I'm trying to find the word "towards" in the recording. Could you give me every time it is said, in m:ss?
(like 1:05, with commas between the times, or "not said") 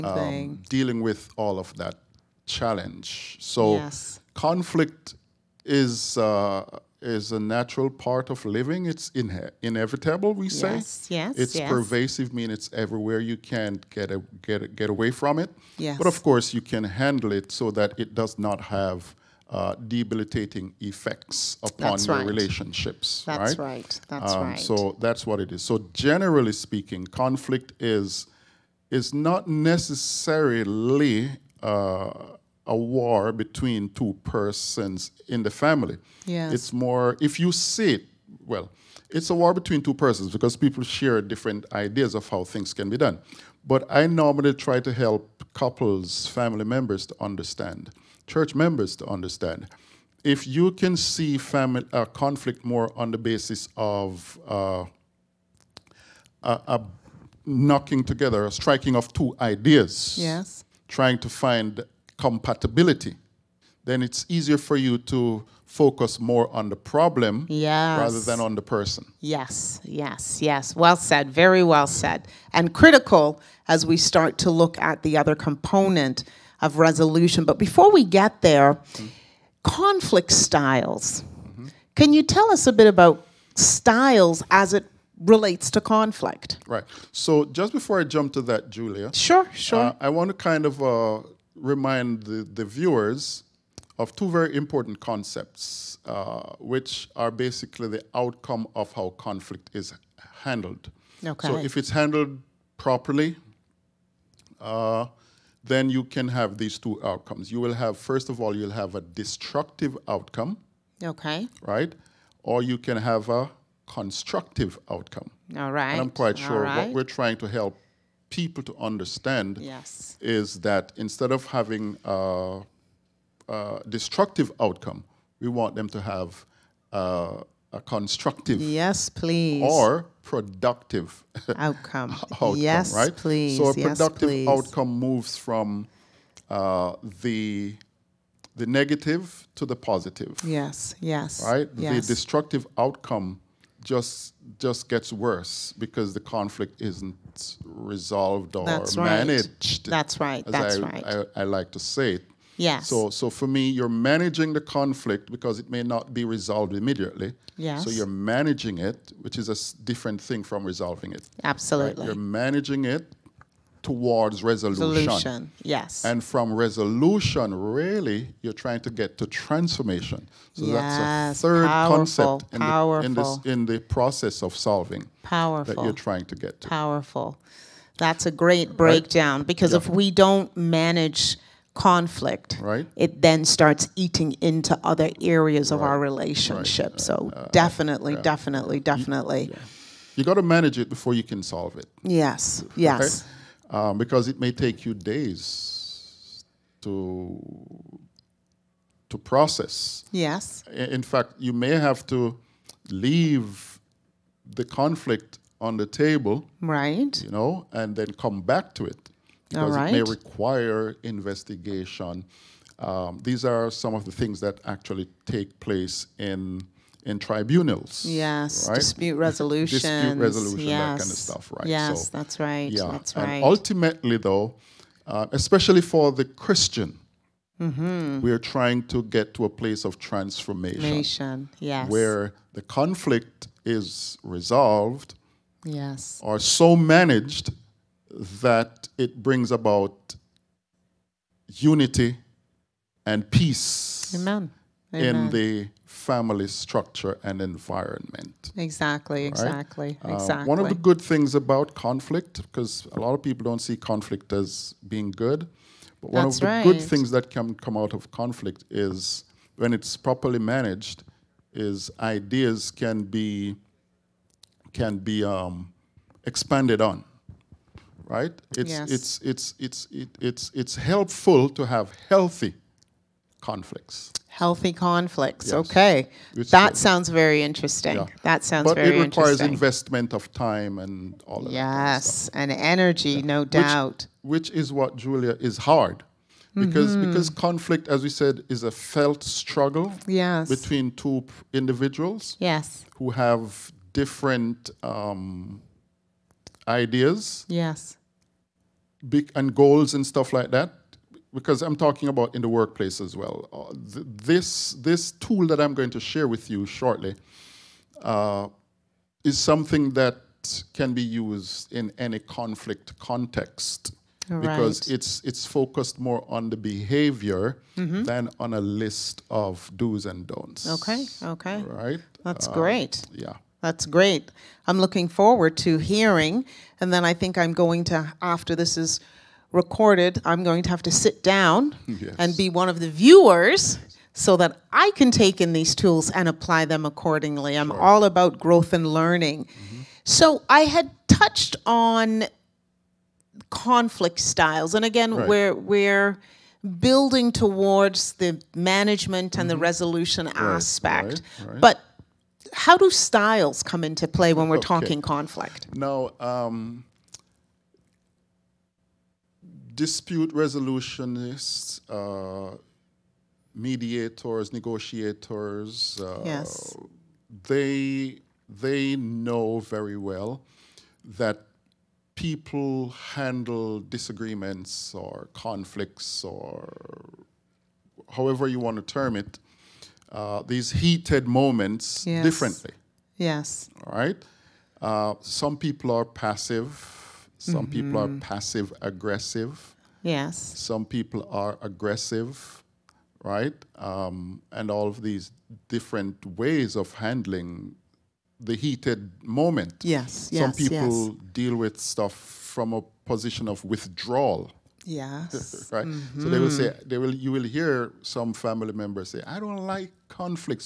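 2:43, 5:47.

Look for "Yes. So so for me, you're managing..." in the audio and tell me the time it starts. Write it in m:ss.
2:32.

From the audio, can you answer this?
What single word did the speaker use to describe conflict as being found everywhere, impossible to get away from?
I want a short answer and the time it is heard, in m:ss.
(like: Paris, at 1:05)
Pervasive, at 0:11.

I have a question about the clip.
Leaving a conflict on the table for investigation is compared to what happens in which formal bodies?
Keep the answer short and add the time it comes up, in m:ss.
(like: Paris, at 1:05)
Tribunals, at 3:37.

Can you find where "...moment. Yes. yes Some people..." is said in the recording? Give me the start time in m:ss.
6:39.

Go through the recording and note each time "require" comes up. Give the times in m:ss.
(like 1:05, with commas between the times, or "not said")
3:30, 4:39.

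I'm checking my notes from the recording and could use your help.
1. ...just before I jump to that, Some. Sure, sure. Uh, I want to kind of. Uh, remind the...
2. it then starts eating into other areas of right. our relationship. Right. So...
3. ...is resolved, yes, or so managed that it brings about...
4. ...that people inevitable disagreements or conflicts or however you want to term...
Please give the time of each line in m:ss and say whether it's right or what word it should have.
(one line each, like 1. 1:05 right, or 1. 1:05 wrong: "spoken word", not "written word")
1. 1:27 wrong: "Julia", not "Some"
2. 3:02 right
3. 3:53 right
4. 6:11 wrong: "handle", not "inevitable".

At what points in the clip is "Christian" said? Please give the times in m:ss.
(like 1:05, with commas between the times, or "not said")
3:46.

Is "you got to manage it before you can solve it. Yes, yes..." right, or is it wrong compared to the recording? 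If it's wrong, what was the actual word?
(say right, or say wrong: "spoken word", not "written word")
right.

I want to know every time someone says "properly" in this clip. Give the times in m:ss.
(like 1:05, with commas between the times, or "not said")
1:42, 4:19.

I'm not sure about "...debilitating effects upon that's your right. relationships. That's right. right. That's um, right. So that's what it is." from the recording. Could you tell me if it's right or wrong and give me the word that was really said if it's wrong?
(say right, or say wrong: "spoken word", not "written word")
right.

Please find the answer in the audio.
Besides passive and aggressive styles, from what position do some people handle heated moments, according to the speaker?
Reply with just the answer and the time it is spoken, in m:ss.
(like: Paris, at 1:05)
Withdrawal, at 6:43.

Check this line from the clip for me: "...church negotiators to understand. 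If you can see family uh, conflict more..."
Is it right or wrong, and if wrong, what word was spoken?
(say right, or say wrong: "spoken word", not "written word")
wrong: "members", not "negotiators".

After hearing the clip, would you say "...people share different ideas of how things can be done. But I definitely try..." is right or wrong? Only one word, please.
wrong.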